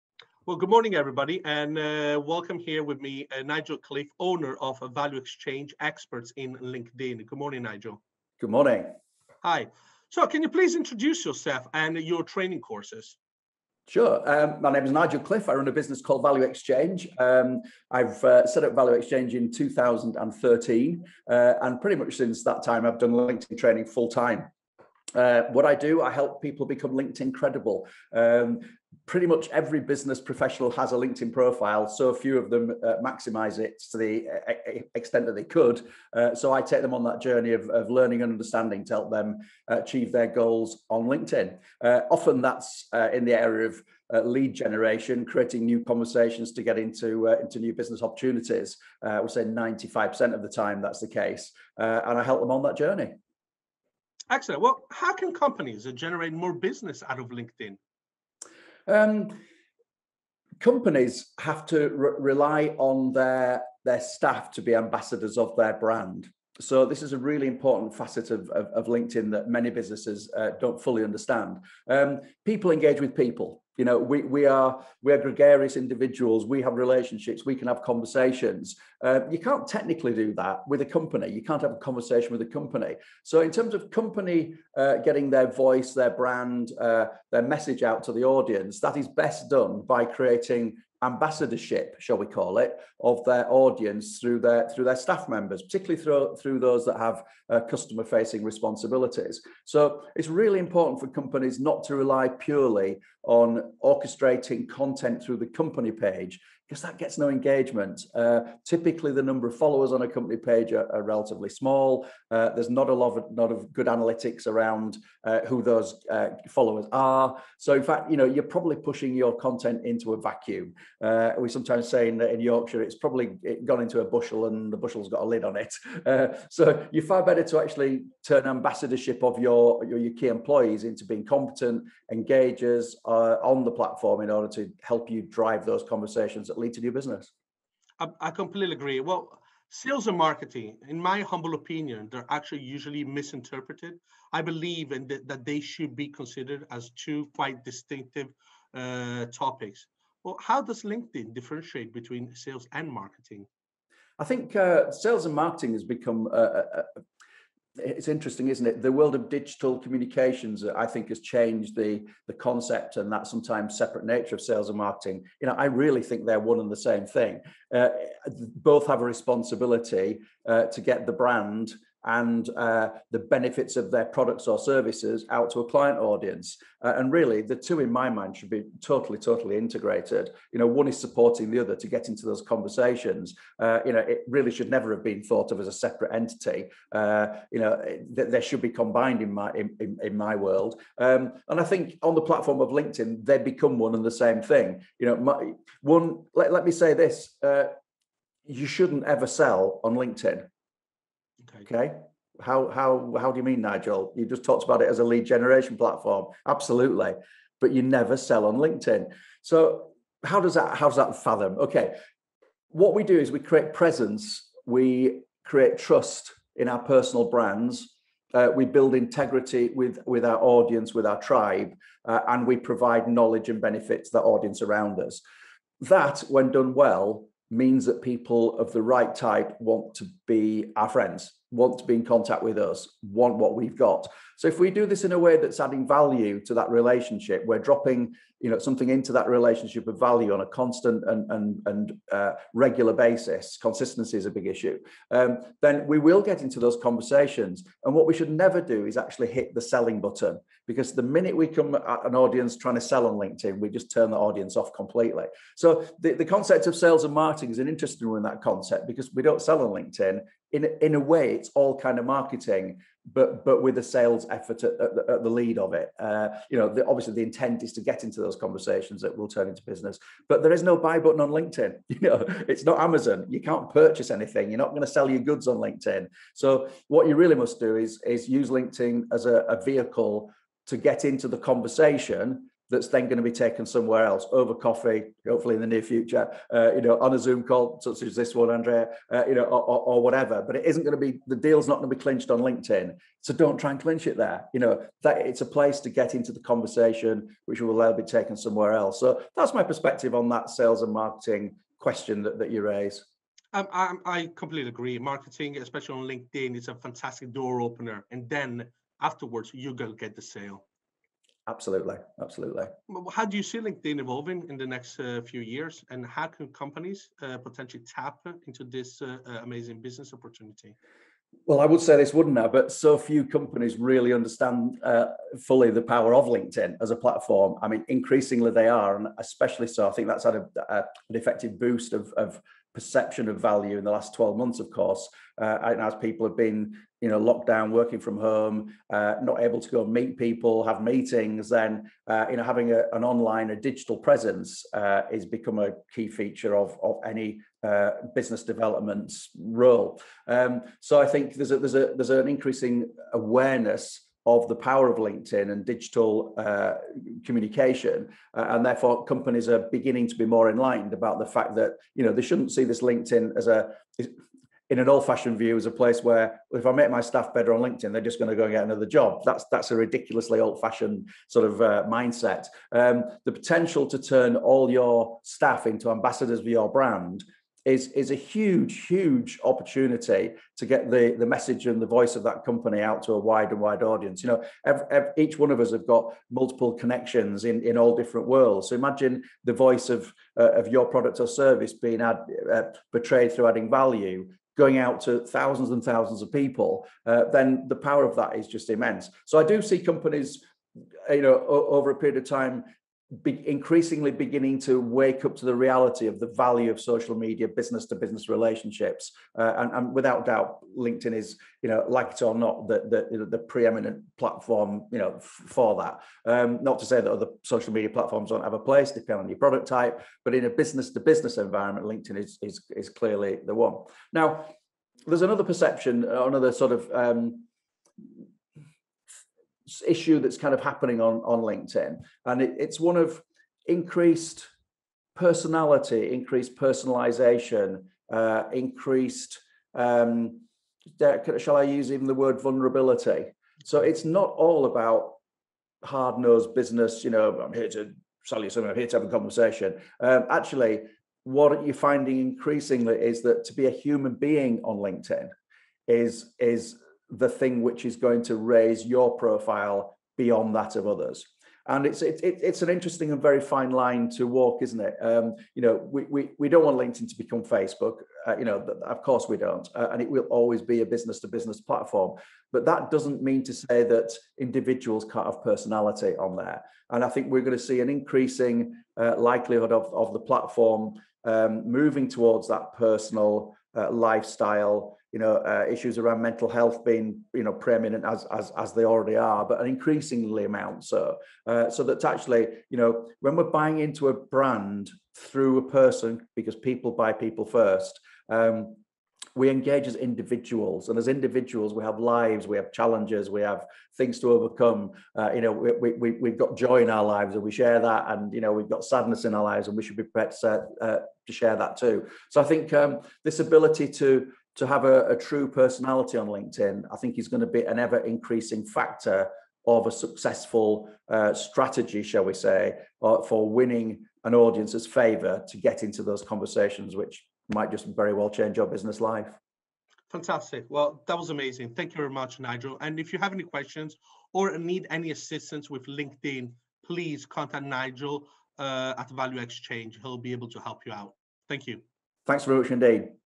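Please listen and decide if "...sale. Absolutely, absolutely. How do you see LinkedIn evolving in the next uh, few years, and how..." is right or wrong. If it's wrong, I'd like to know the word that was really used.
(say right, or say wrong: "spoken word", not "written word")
right.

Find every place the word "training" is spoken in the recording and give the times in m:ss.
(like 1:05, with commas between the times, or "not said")
0:12, 0:23.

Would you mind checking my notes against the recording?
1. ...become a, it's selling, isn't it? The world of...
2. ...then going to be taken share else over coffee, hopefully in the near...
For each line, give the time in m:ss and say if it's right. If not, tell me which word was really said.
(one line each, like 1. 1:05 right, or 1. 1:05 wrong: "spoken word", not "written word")
1. 2:35 wrong: "interesting", not "selling"
2. 4:42 wrong: "somewhere", not "share".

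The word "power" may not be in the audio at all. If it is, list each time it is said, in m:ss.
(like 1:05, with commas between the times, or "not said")
5:25, 5:54, 6:37.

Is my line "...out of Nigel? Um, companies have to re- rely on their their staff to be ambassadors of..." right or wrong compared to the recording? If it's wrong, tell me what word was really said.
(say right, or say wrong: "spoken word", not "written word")
wrong: "LinkedIn", not "Nigel".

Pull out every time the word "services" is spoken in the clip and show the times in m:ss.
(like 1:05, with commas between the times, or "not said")
2:54, 6:31.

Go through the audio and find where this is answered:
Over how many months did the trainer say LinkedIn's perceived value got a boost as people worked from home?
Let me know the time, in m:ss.
5:34.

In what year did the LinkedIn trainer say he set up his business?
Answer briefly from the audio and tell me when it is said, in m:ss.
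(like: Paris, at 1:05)
2013, at 0:19.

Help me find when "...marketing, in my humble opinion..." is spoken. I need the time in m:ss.
2:20.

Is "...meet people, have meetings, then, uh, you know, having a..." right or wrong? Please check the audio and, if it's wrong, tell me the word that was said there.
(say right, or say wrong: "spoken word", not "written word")
right.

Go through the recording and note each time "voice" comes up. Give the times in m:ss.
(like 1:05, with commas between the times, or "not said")
1:25, 6:21, 6:29.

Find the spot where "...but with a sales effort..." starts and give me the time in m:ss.
4:23.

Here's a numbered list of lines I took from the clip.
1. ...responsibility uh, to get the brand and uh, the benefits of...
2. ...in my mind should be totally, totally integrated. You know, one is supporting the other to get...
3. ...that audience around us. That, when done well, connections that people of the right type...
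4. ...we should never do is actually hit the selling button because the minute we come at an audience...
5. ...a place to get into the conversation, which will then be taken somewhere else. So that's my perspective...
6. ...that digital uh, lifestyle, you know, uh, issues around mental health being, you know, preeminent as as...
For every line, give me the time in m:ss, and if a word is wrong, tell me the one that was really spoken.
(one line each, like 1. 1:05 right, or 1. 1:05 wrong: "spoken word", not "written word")
1. 2:49 right
2. 2:57 right
3. 3:44 wrong: "means", not "connections"
4. 4:08 right
5. 4:55 right
6. 8:02 wrong: "personal", not "digital".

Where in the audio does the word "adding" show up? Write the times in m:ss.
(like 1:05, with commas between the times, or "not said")
3:55, 6:33.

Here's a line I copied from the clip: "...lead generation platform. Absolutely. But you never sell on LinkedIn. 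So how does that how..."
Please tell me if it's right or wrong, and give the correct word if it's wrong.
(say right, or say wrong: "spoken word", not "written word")
right.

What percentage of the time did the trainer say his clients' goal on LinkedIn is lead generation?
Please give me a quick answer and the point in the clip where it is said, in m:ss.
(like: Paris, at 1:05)
95%, at 0:49.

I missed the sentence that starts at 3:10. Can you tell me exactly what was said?
Um, and I think on the platform of LinkedIn, they become one and the same thing.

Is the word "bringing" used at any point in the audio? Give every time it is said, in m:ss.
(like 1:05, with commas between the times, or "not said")
not said.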